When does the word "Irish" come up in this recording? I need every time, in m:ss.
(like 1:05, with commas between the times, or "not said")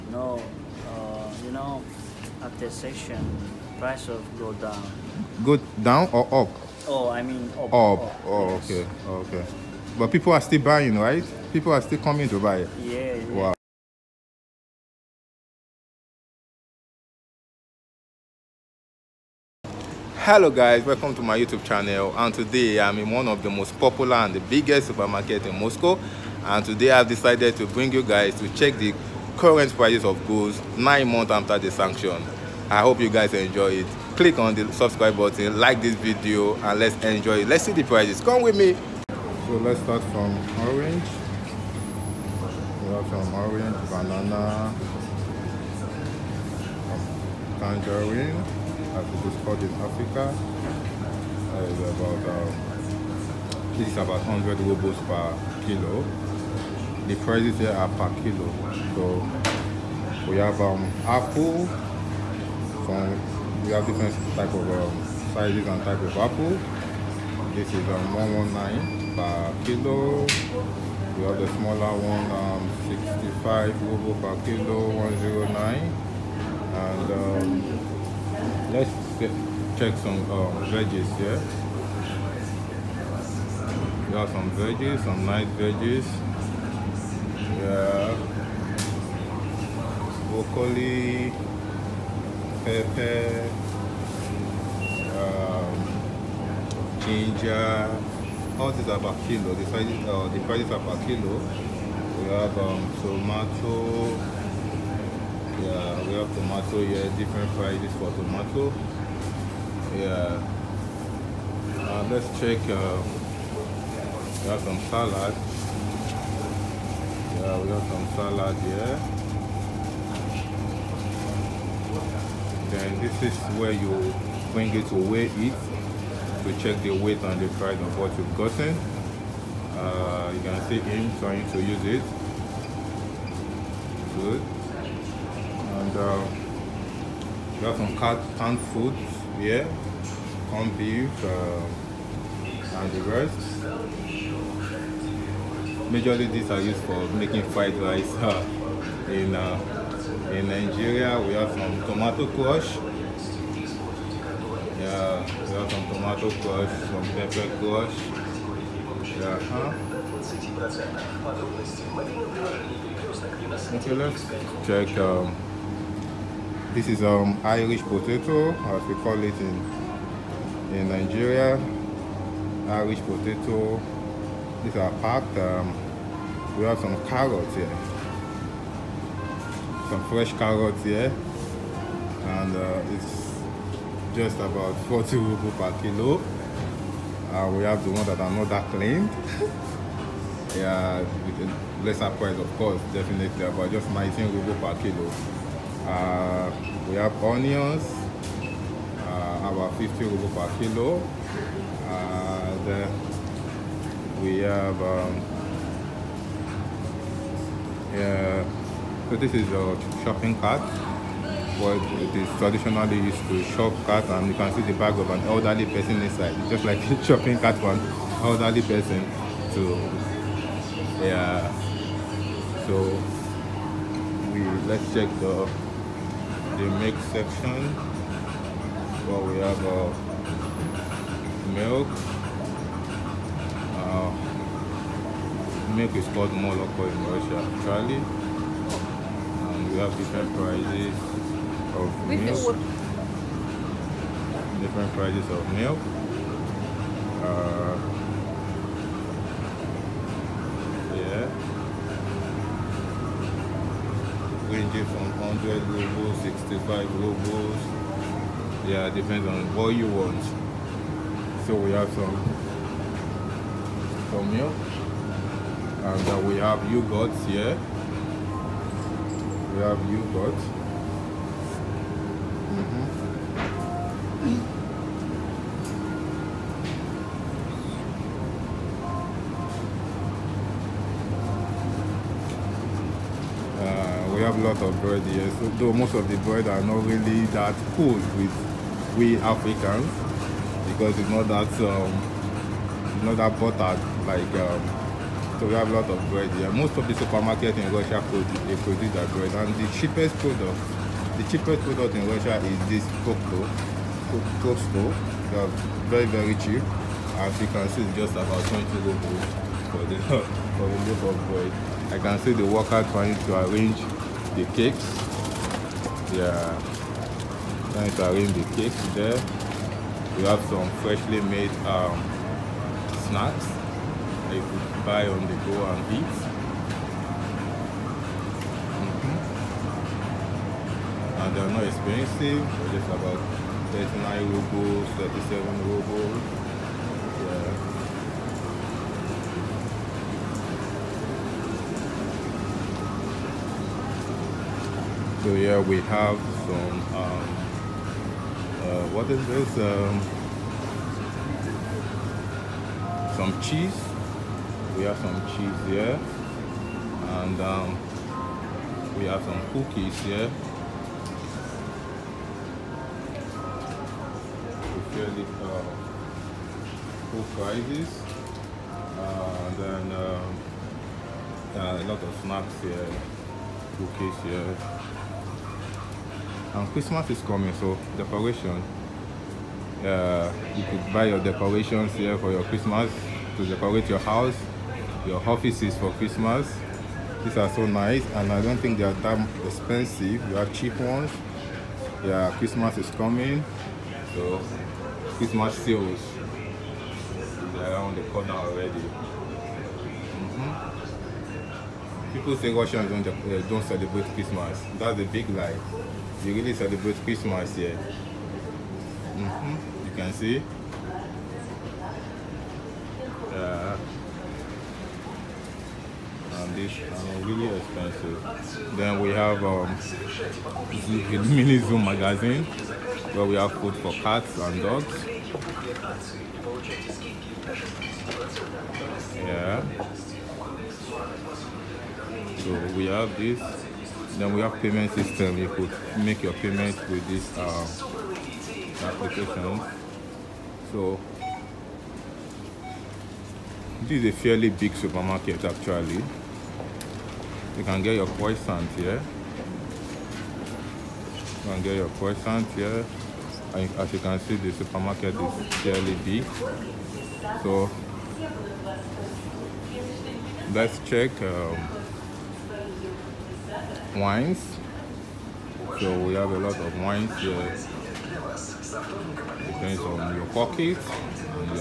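2:47, 2:52.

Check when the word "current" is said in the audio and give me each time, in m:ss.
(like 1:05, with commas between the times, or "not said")
0:29.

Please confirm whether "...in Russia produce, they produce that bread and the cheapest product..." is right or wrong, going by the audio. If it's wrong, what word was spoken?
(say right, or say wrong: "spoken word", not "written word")
right.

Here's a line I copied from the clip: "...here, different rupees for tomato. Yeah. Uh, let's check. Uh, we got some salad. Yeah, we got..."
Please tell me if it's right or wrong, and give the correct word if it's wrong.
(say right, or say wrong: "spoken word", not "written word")
wrong: "prices", not "rupees".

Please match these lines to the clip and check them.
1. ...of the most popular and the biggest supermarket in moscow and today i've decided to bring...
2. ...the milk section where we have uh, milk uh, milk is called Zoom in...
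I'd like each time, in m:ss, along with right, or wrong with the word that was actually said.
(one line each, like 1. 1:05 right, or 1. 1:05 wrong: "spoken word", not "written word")
1. 0:23 right
2. 3:46 wrong: "Moloko", not "Zoom".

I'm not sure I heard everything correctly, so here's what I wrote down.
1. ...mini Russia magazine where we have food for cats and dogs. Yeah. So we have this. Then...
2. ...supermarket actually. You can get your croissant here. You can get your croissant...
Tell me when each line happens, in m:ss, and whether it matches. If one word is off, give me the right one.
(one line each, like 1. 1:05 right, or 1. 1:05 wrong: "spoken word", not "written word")
1. 7:01 wrong: "Zoom", not "Russia"
2. 7:24 right.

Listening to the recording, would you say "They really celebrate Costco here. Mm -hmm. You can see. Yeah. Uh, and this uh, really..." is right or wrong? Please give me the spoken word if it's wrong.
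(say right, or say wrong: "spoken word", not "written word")
wrong: "Christmas", not "Costco".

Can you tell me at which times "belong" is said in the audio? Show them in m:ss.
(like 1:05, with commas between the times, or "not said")
not said.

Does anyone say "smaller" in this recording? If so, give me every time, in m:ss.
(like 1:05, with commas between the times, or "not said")
1:11.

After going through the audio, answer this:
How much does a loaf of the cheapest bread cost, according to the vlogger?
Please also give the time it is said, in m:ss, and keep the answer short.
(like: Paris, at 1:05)
20 rubles, at 5:08.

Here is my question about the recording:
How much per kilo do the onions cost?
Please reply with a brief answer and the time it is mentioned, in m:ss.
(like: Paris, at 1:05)
50 rubles, at 3:19.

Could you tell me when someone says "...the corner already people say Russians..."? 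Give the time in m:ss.
6:37.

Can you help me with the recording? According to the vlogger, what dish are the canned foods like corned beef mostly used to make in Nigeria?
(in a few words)
Fried rice.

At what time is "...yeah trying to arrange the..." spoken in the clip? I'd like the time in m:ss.
5:16.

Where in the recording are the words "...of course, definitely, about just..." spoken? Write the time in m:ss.
3:12.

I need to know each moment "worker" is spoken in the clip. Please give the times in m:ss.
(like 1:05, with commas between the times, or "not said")
5:12.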